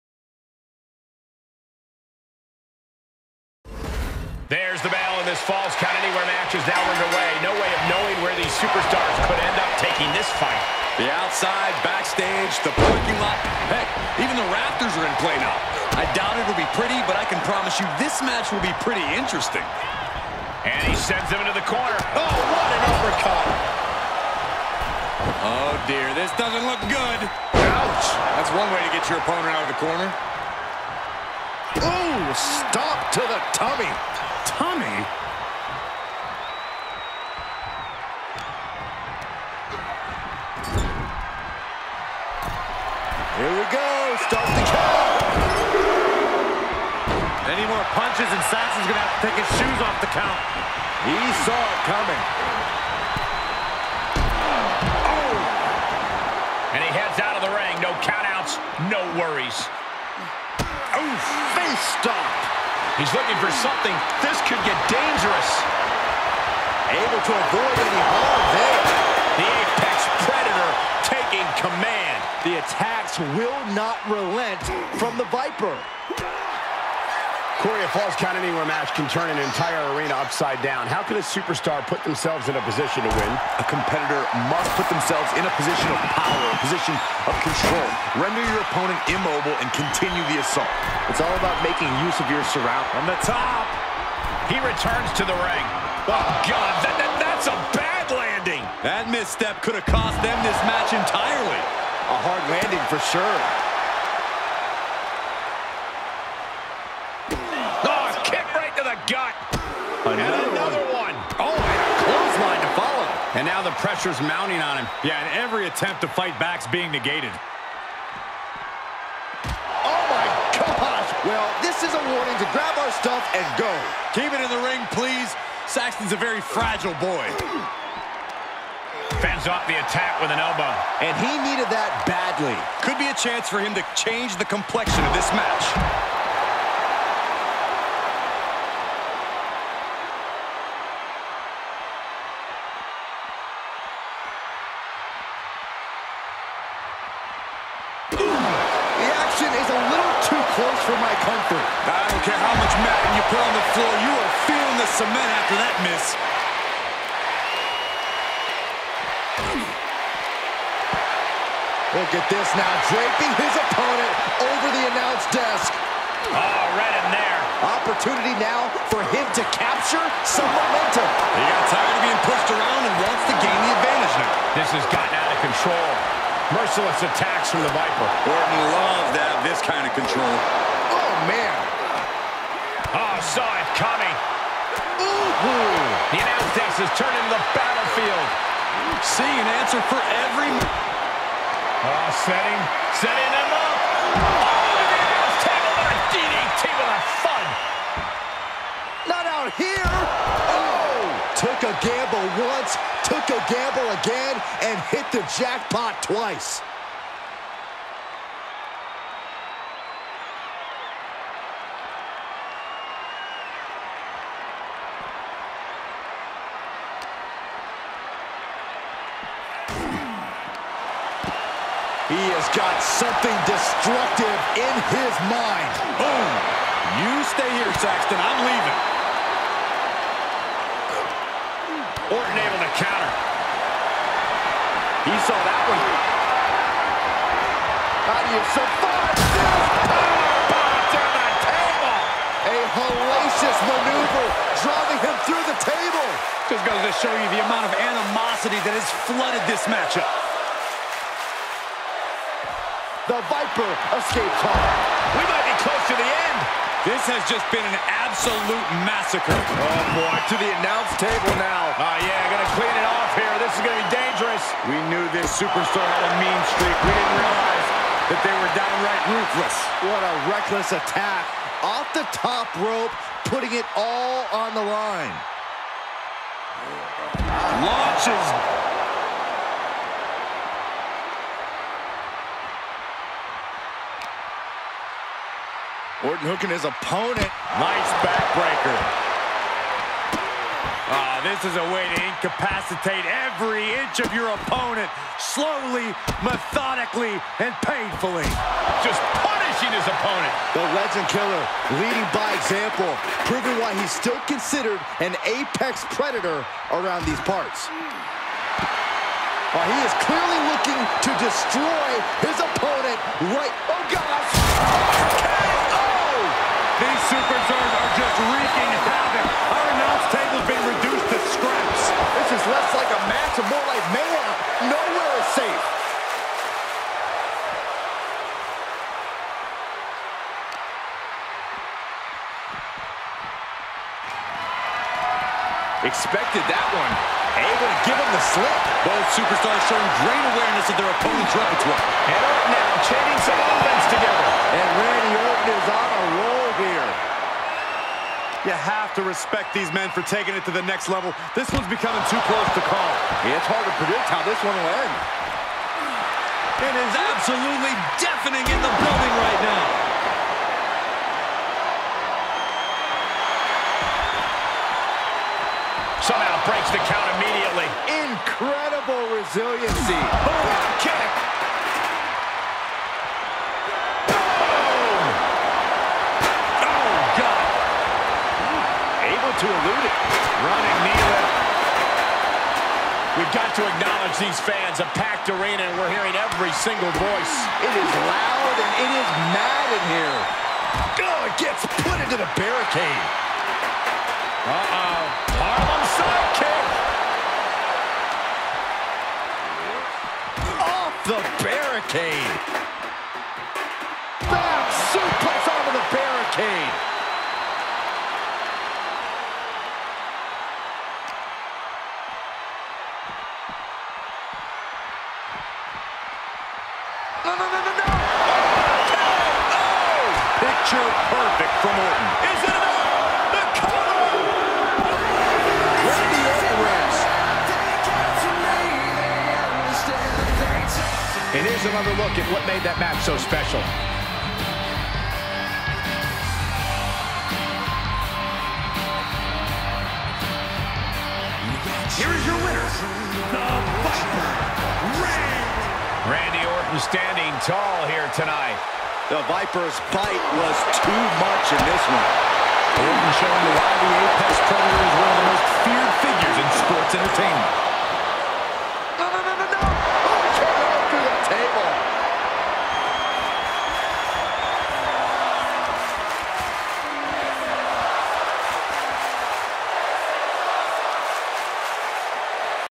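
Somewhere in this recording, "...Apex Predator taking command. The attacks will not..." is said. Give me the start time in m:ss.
1:09.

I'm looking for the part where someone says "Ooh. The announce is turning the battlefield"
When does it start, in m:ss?
3:04.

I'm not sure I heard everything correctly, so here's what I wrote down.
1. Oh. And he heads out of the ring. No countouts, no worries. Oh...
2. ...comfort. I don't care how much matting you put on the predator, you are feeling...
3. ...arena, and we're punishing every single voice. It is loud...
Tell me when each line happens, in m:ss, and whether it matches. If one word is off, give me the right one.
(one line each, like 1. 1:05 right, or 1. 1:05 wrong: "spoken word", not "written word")
1. 0:54 right
2. 2:31 wrong: "floor", not "predator"
3. 6:25 wrong: "hearing", not "punishing".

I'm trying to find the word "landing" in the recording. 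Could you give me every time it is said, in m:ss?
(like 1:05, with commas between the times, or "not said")
1:38, 1:42.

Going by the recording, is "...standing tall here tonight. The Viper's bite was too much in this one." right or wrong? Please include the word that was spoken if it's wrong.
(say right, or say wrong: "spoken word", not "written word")
right.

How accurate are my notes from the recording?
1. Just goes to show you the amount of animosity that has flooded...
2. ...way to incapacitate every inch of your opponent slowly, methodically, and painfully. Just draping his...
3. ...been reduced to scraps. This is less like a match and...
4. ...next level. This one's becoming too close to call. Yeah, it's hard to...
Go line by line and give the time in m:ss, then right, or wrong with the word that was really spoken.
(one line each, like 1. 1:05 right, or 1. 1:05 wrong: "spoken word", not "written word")
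1. 4:06 right
2. 4:51 wrong: "punishing", not "draping"
3. 5:20 right
4. 5:50 right.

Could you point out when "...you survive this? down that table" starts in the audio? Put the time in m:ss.
3:58.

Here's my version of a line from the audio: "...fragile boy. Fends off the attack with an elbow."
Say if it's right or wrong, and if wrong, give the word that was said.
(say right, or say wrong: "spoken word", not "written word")
right.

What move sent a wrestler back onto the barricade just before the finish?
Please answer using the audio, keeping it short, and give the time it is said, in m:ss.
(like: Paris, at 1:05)
Back suplex, at 6:44.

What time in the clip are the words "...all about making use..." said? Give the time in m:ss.
1:31.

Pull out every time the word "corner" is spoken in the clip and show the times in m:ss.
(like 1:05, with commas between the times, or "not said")
0:21, 0:29.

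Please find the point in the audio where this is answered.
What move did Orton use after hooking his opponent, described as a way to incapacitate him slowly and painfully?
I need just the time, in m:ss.
4:48.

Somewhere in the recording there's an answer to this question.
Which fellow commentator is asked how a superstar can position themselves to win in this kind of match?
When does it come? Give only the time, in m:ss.
1:17.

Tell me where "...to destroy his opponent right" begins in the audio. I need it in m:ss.
5:10.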